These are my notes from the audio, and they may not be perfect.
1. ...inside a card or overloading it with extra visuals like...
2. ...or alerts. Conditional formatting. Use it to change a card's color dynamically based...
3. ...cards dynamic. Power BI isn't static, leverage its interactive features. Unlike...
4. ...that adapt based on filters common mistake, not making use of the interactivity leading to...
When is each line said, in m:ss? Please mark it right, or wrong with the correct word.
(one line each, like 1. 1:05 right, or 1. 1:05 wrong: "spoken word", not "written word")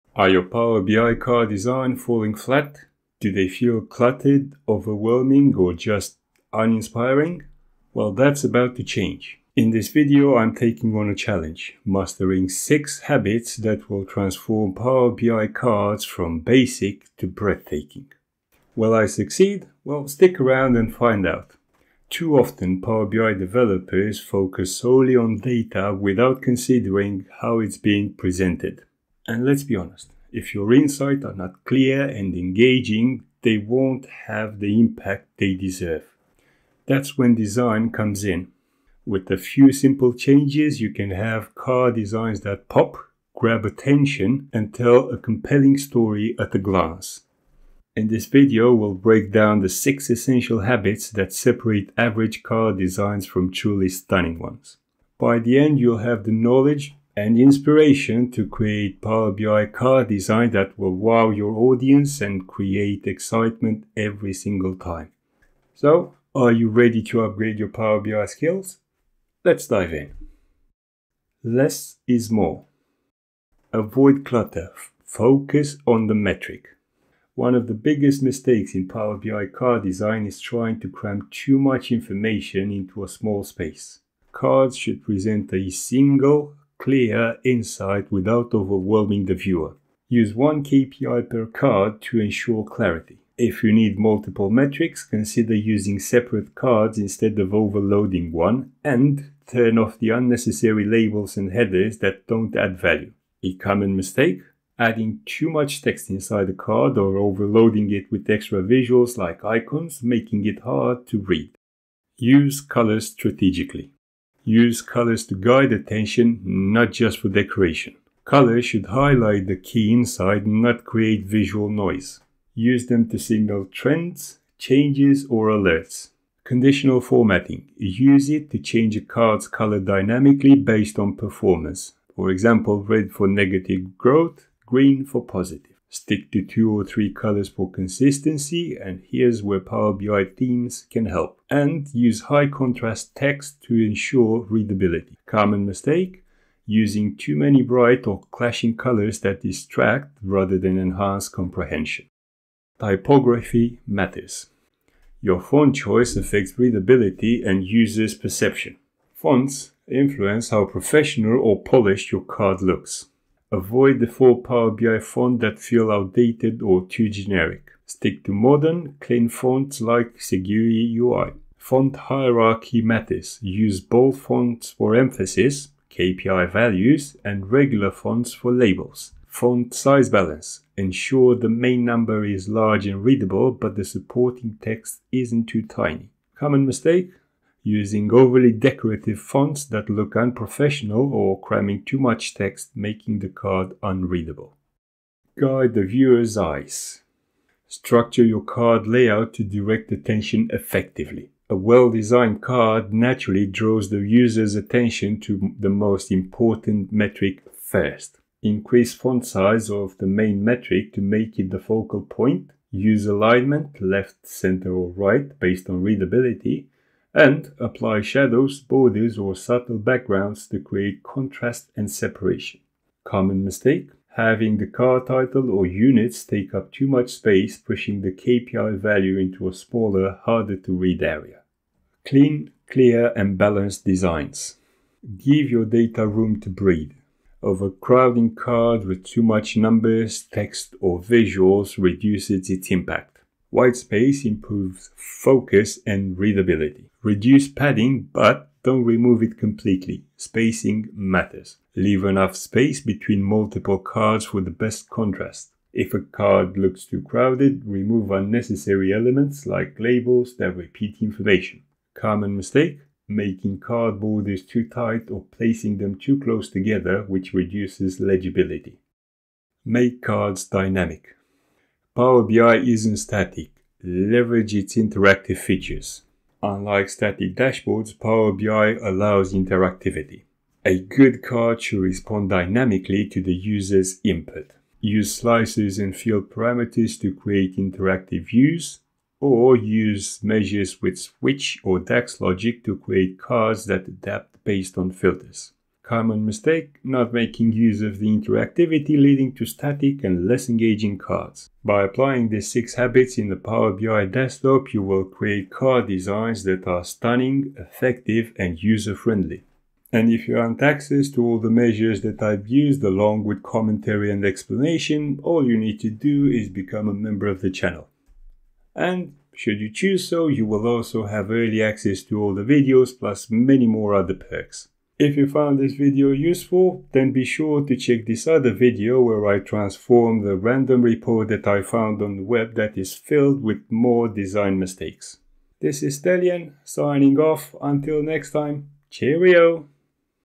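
1. 1:46 right
2. 2:05 right
3. 4:30 right
4. 4:53 right.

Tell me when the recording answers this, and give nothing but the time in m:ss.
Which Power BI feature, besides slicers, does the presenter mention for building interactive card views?
4:45.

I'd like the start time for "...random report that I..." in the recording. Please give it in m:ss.
5:30.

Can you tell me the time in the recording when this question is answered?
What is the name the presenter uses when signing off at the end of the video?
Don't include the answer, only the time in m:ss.
5:35.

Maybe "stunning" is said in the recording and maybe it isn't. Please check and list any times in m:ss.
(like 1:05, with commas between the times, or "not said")
0:53, 5:06.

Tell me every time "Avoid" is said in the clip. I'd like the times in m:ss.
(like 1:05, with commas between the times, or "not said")
1:13, 2:43.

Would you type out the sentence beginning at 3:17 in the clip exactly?
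Structure your card layout to direct attention effectively.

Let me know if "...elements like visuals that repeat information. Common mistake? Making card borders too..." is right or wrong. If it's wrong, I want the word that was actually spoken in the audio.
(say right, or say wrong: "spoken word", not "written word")
wrong: "labels", not "visuals".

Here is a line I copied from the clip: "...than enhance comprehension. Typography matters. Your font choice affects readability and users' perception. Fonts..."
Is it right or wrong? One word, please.
right.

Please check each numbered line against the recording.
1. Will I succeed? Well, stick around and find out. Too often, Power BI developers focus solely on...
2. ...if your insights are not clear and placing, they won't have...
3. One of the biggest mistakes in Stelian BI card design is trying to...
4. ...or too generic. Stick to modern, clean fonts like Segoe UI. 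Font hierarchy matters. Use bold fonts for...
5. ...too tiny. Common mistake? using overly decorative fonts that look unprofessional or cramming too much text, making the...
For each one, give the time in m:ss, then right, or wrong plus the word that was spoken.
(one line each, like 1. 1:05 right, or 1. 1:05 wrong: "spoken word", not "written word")
1. 0:18 right
2. 0:30 wrong: "engaging", not "placing"
3. 1:17 wrong: "Power", not "Stelian"
4. 2:46 right
5. 3:05 right.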